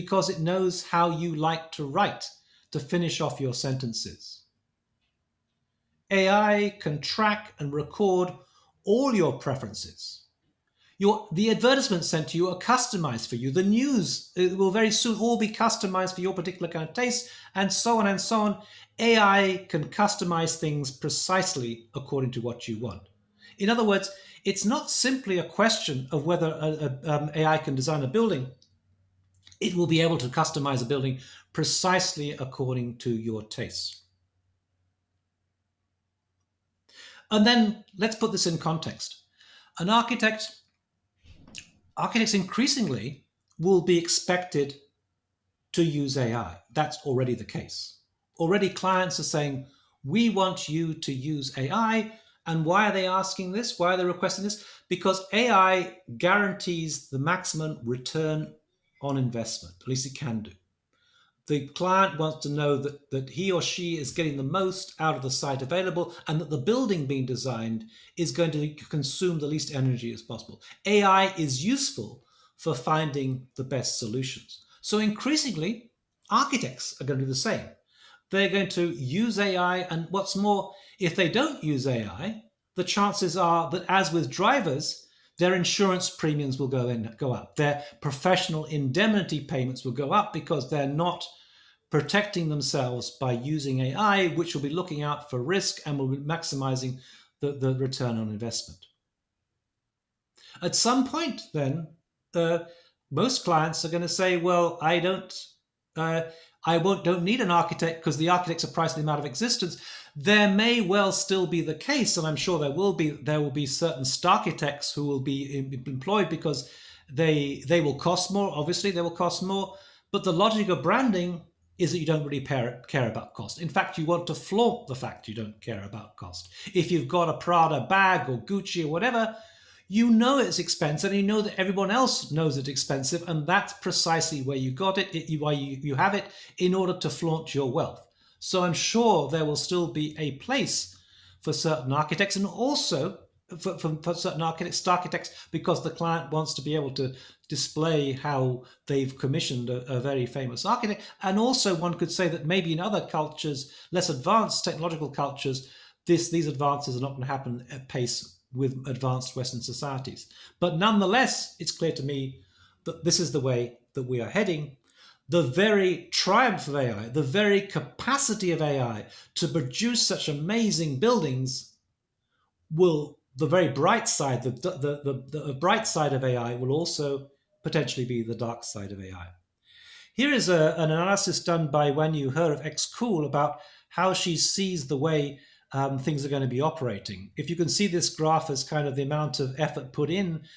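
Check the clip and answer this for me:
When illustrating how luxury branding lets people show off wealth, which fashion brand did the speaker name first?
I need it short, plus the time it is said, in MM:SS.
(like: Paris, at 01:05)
Prada, at 02:07.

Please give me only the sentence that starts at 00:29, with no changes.
It will be able to customize a building precisely according to your tastes.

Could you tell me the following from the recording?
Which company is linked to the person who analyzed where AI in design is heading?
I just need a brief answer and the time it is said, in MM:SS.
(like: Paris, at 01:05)
XKool, at 03:02.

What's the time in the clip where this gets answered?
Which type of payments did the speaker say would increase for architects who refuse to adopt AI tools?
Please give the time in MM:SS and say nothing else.
01:28.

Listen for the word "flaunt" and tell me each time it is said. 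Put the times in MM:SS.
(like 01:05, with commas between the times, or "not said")
02:04, 02:17.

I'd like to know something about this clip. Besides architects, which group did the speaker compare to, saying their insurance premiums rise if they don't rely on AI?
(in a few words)
drivers.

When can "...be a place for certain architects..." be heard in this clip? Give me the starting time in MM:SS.
02:19.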